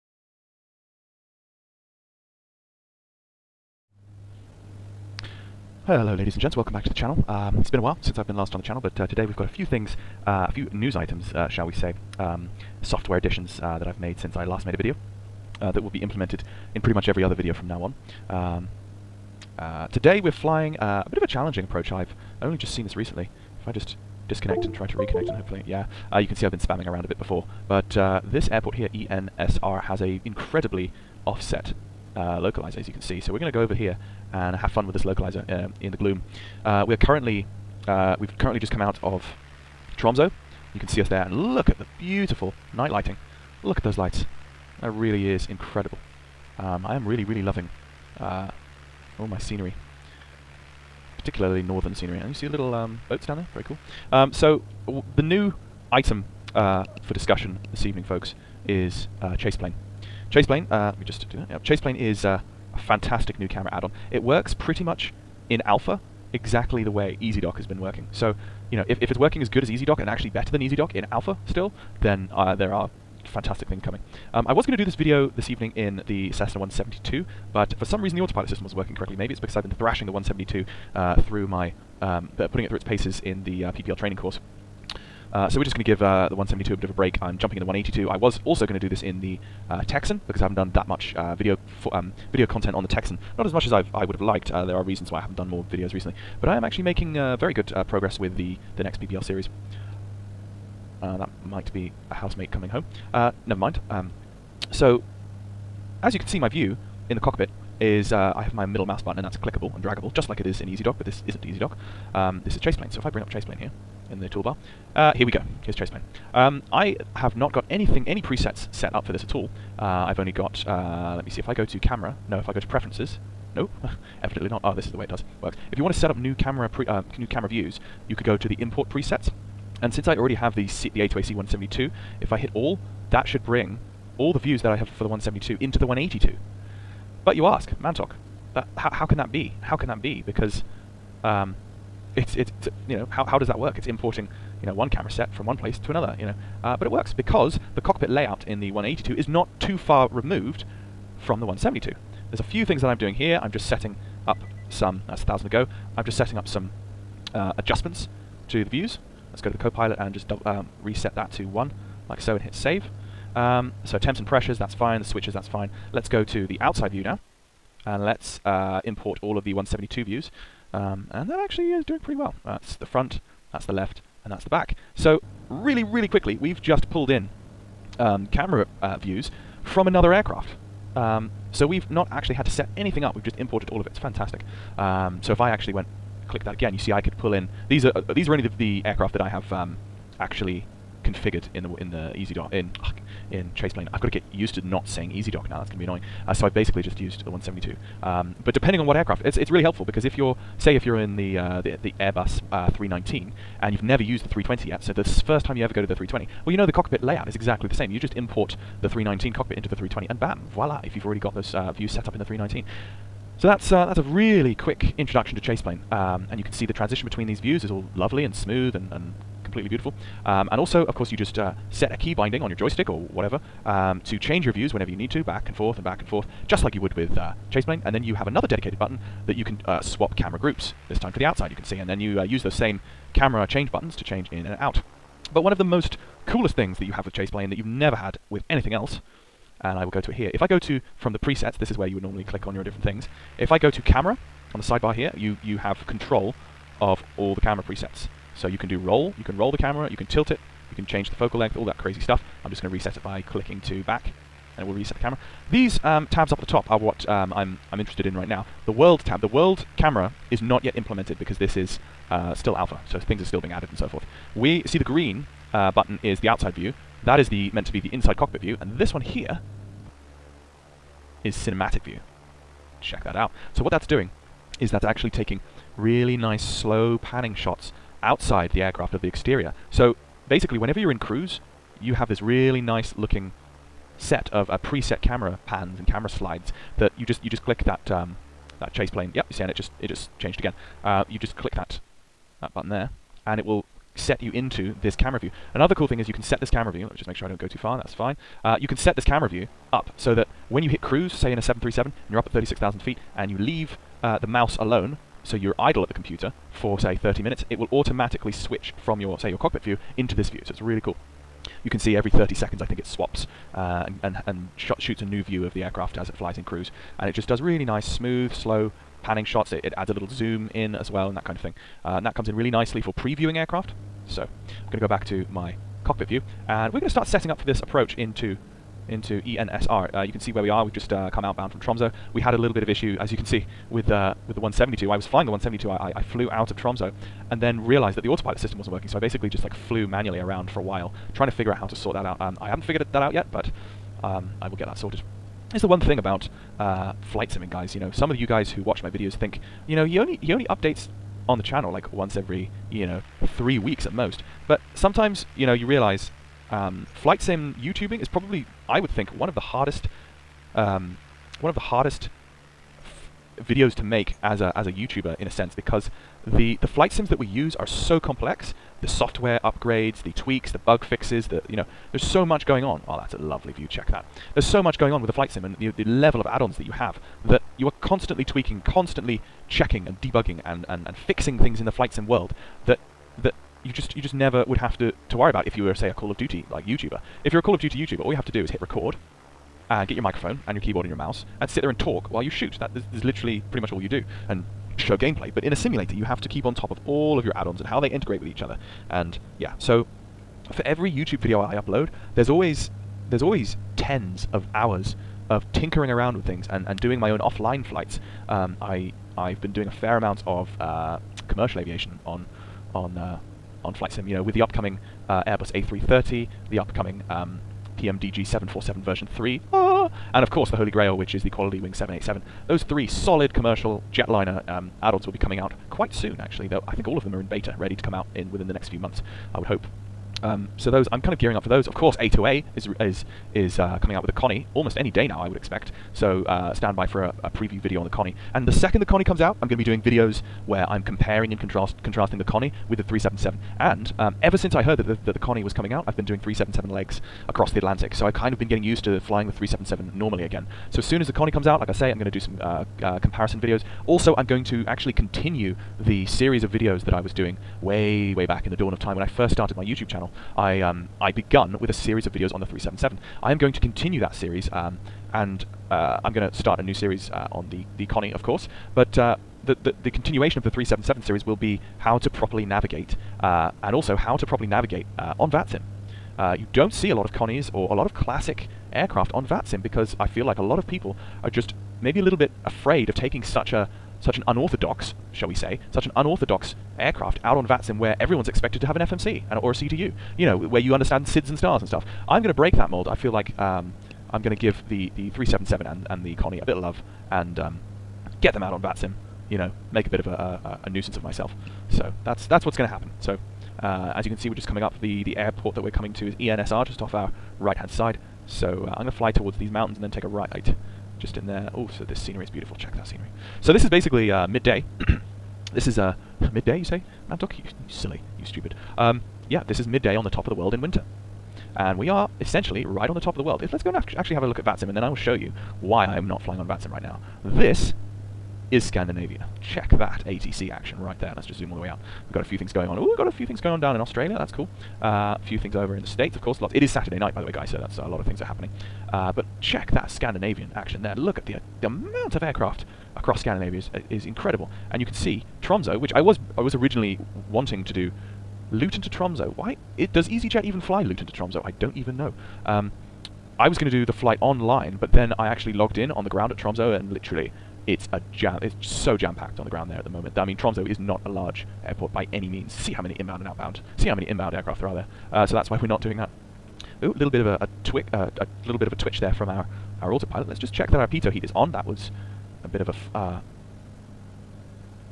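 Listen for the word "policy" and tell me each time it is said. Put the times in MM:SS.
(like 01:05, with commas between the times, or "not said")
not said.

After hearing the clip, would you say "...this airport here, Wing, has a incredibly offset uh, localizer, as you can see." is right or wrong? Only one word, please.
wrong.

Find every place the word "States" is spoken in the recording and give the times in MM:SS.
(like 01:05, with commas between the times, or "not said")
08:55.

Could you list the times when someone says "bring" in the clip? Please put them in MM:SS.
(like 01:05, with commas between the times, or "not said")
01:53, 02:13.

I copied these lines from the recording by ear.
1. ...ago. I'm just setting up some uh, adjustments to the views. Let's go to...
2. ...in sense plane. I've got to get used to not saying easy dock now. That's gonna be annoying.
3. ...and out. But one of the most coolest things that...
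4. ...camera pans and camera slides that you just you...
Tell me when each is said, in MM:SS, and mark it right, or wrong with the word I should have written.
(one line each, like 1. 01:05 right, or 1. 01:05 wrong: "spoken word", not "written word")
1. 02:35 right
2. 03:13 wrong: "chase", not "sense"
3. 03:54 right
4. 04:45 right.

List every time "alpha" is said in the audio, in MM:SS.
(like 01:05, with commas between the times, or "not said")
01:05, 01:11, 04:22.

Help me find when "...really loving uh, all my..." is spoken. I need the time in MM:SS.
00:47.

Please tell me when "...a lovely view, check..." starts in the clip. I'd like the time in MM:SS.
06:13.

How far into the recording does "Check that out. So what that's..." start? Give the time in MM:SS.
04:32.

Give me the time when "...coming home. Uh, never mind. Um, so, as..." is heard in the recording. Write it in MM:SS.
01:42.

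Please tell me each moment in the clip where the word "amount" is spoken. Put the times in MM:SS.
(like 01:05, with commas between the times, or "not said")
06:49, 09:01.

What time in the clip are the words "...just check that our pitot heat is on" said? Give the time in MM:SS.
09:30.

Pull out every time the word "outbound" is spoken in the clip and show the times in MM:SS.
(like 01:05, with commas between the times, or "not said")
05:31, 09:23.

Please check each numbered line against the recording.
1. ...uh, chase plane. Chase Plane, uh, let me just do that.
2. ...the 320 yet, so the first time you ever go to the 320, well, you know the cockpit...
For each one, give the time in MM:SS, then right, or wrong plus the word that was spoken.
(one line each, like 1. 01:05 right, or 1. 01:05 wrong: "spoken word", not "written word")
1. 00:59 right
2. 03:24 right.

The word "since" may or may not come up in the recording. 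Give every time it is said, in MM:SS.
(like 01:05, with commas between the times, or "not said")
00:08, 00:14, 02:09, 07:24.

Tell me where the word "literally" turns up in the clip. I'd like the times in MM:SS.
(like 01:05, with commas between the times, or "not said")
06:33, 09:16.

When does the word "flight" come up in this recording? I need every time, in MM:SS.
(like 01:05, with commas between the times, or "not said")
05:47, 05:56, 06:06, 06:15, 06:21, 06:47, 06:53, 09:13.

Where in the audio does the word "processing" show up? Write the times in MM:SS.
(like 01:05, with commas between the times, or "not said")
not said.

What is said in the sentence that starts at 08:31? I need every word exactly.
Oh, so this scenery is beautiful.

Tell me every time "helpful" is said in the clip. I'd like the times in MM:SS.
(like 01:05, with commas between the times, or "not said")
03:19.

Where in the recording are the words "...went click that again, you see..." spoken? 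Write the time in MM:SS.
03:05.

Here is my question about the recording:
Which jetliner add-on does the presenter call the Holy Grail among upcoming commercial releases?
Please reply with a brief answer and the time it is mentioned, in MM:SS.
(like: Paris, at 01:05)
Quality Wing 787, at 07:01.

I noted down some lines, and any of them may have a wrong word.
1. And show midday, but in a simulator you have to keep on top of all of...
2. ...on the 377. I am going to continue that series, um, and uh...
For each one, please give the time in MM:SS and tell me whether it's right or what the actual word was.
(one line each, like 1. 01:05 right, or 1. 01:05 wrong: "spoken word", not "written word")
1. 06:34 wrong: "gameplay", not "midday"
2. 07:42 right.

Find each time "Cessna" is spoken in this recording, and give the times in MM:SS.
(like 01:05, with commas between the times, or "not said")
01:16.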